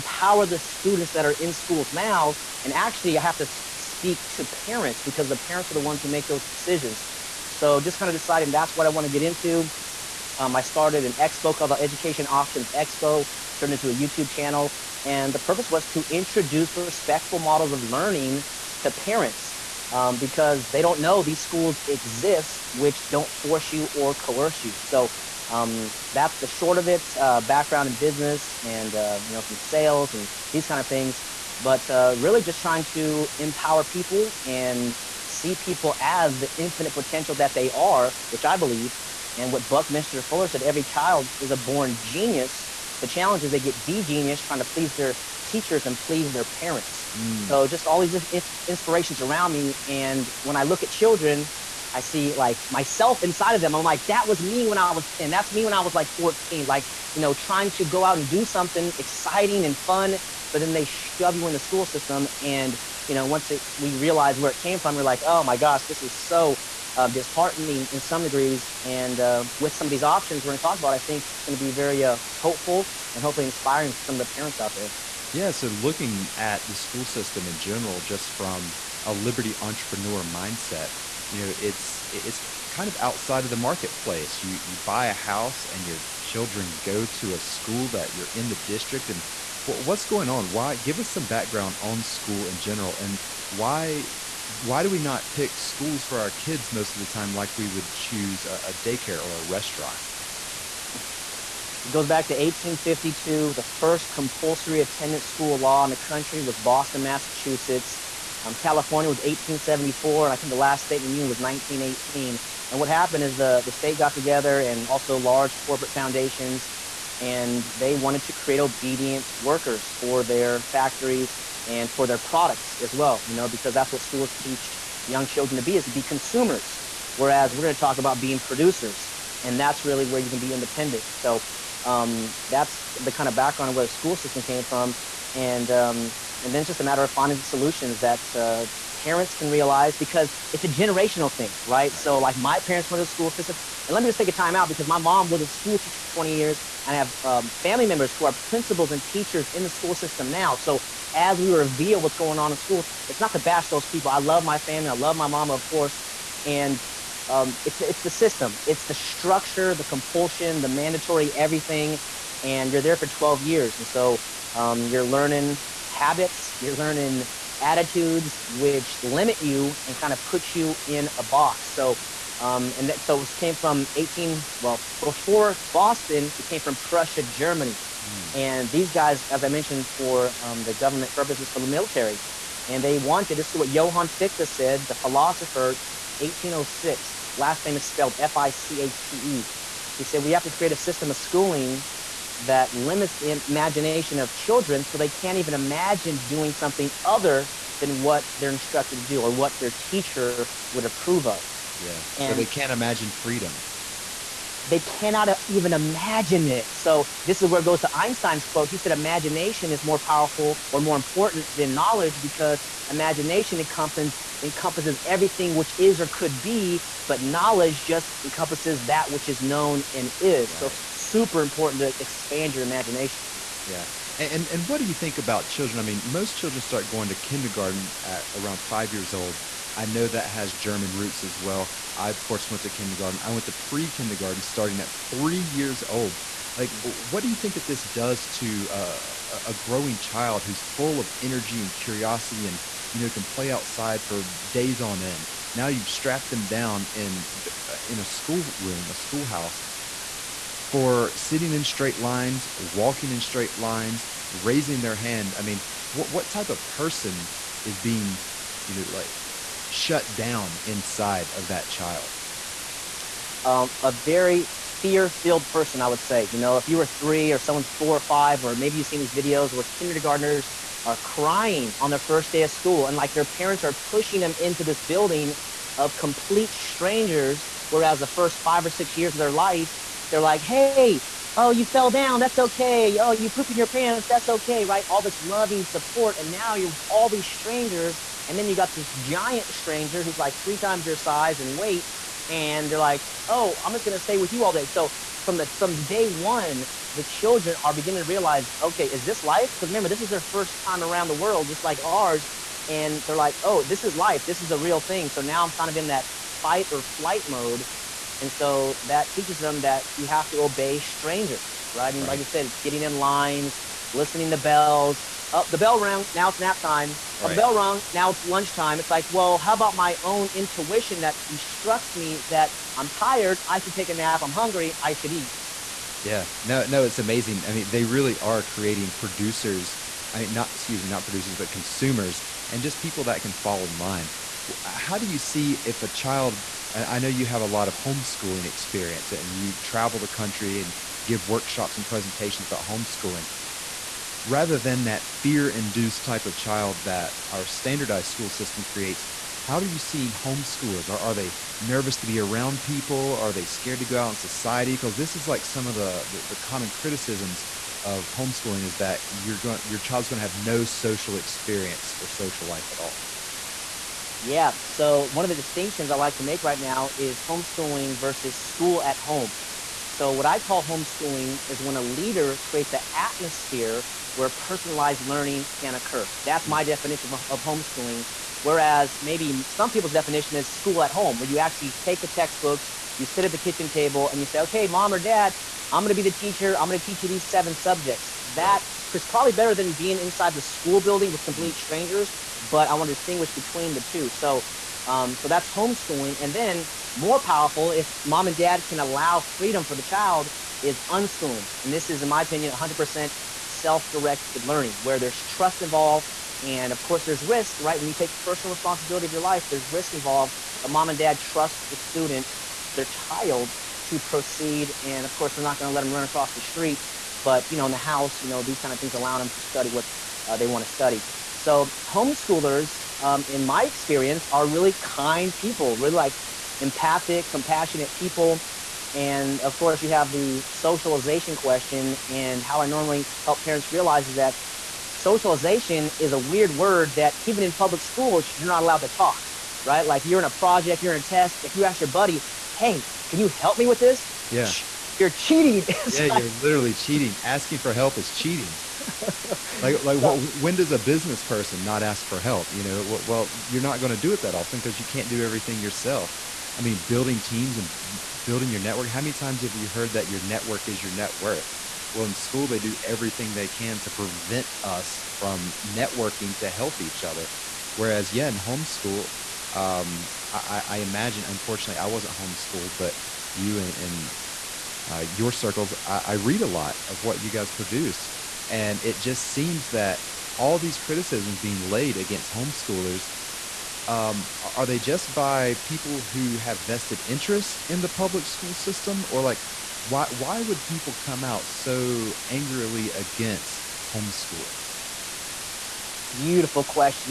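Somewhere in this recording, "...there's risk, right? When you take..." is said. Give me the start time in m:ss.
6:47.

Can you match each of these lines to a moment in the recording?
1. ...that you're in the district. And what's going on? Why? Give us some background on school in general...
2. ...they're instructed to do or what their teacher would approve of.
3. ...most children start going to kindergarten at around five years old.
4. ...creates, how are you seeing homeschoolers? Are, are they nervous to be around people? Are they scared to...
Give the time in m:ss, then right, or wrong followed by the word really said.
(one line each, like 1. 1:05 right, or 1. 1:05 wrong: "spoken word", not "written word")
1. 1:27 right
2. 3:18 right
3. 3:46 right
4. 5:48 right.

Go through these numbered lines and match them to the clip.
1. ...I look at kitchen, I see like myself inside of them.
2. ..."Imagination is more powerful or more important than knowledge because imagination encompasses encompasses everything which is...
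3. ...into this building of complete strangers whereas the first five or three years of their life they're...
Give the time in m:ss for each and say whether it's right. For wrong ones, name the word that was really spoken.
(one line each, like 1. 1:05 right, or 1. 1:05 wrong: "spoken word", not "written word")
1. 0:50 wrong: "children", not "kitchen"
2. 3:28 right
3. 4:34 wrong: "six", not "three".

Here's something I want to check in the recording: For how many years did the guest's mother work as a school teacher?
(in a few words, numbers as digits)
20.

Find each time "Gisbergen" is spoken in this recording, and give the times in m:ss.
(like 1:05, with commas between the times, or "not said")
not said.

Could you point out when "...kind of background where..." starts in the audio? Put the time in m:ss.
2:13.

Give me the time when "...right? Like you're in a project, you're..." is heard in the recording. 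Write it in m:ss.
7:19.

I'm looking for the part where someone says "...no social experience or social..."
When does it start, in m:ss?
6:00.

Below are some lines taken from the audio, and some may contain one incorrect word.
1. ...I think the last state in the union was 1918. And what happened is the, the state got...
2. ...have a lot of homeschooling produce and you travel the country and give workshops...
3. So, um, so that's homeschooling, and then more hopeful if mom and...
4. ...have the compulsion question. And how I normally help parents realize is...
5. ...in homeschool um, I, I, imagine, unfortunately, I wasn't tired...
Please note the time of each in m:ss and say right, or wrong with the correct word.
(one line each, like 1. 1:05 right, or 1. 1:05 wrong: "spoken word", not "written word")
1. 1:50 right
2. 5:37 wrong: "experience", not "produce"
3. 6:34 wrong: "powerful", not "hopeful"
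4. 7:09 wrong: "socialization", not "compulsion"
5. 7:48 wrong: "homeschooled", not "tired".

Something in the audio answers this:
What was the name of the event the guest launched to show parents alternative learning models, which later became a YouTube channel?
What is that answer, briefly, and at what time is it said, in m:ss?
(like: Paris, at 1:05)
Education Options Expo, at 0:11.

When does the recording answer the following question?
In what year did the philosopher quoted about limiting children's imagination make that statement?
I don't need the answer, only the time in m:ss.
3:06.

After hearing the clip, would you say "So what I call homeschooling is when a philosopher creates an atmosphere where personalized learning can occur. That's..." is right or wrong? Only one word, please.
wrong.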